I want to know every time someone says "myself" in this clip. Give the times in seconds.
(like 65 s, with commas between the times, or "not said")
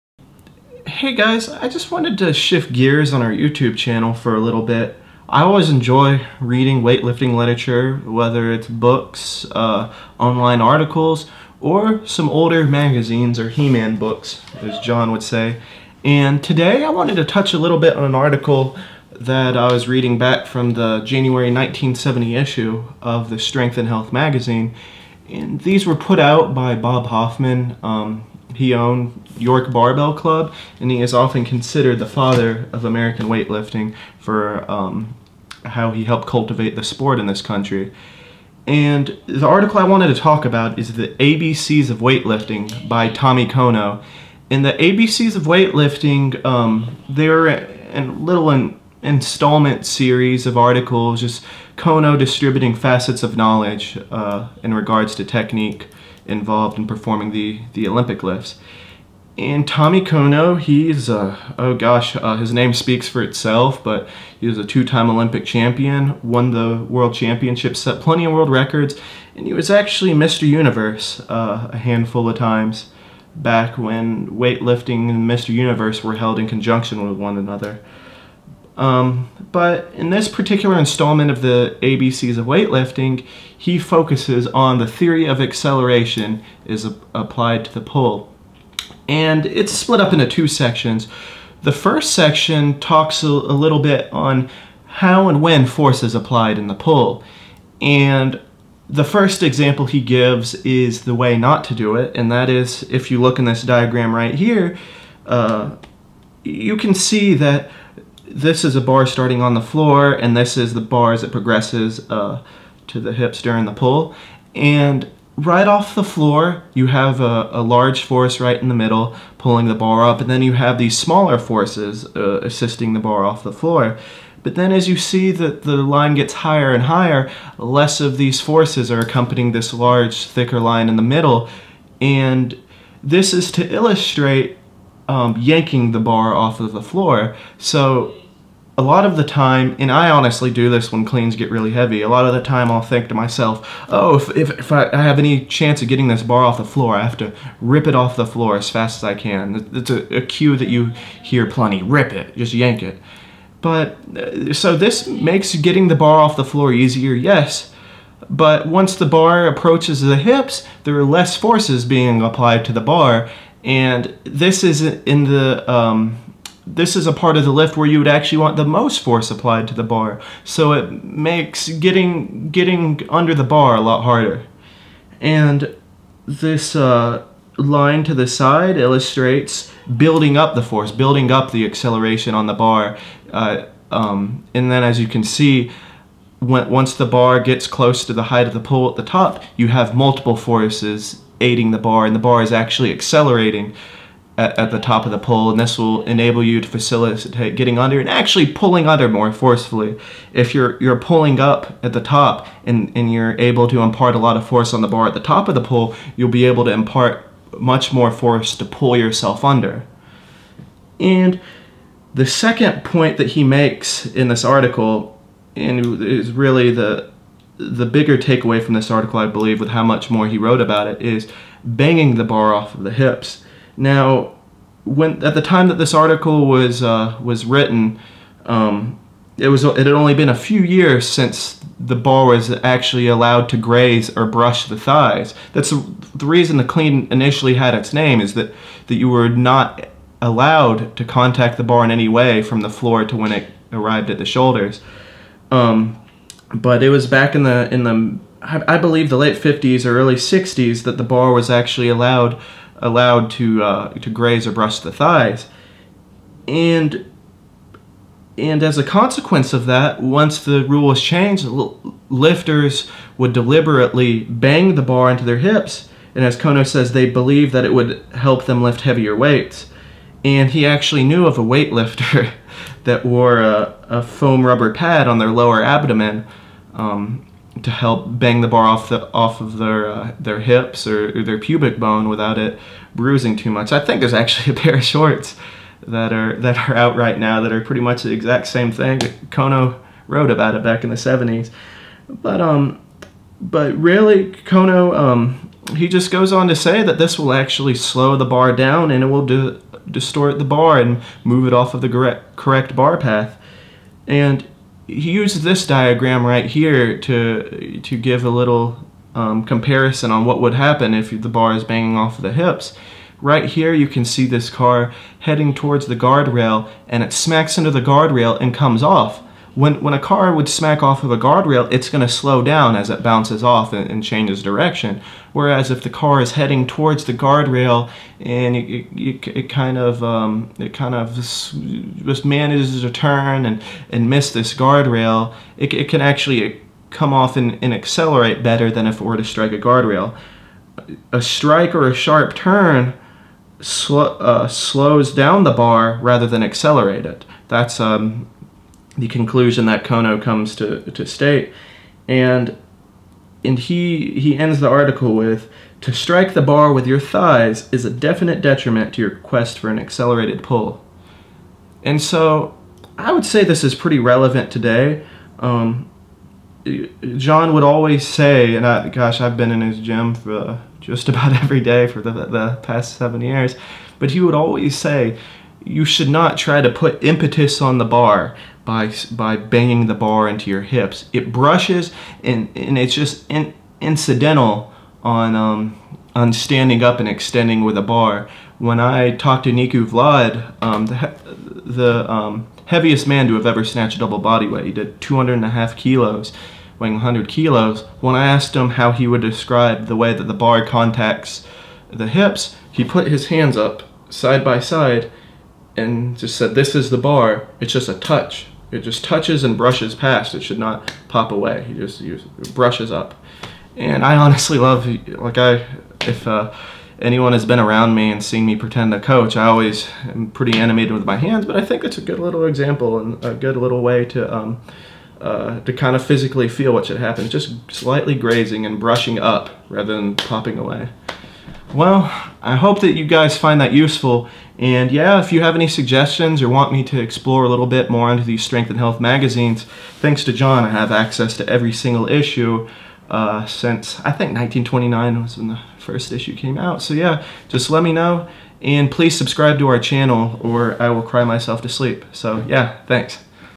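143 s, 451 s.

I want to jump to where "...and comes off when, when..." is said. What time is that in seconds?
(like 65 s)
318 s.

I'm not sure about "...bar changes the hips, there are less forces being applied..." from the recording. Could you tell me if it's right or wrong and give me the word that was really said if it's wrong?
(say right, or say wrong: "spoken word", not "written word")
wrong: "approaches", not "changes".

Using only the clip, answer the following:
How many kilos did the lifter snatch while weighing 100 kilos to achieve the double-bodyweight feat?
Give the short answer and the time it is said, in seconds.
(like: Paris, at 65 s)
200.5 kilos, at 395 s.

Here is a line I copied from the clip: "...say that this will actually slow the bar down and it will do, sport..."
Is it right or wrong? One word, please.
wrong.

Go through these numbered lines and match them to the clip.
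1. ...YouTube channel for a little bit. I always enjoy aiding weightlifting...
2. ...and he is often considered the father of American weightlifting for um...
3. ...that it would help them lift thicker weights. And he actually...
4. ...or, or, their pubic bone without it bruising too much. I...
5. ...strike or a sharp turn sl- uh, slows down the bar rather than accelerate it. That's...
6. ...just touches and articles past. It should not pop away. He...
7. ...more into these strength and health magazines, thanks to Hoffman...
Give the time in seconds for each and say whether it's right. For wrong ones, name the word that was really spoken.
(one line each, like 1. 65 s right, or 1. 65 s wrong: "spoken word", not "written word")
1. 3 s wrong: "reading", not "aiding"
2. 30 s right
3. 267 s wrong: "heavier", not "thicker"
4. 280 s right
5. 341 s right
6. 408 s wrong: "brushes", not "articles"
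7. 437 s wrong: "John", not "Hoffman".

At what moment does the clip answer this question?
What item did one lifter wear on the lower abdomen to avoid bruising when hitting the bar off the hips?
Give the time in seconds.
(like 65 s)
274 s.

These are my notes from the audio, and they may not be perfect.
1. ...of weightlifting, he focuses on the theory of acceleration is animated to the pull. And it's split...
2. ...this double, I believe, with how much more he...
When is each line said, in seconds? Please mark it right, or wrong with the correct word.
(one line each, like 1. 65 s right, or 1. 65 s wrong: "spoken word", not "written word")
1. 82 s wrong: "applied", not "animated"
2. 218 s wrong: "article", not "double".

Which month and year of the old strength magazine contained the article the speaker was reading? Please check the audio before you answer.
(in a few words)
January 1970.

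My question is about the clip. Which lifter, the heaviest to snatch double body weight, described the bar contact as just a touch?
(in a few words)
Nicu Vlad.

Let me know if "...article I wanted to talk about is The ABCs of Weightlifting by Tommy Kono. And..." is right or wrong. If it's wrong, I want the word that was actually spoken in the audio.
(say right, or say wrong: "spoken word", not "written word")
right.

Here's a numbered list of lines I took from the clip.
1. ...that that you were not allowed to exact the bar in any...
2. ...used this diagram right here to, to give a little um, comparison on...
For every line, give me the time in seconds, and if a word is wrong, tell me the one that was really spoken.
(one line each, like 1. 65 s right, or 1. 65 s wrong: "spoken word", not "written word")
1. 238 s wrong: "contact", not "exact"
2. 305 s right.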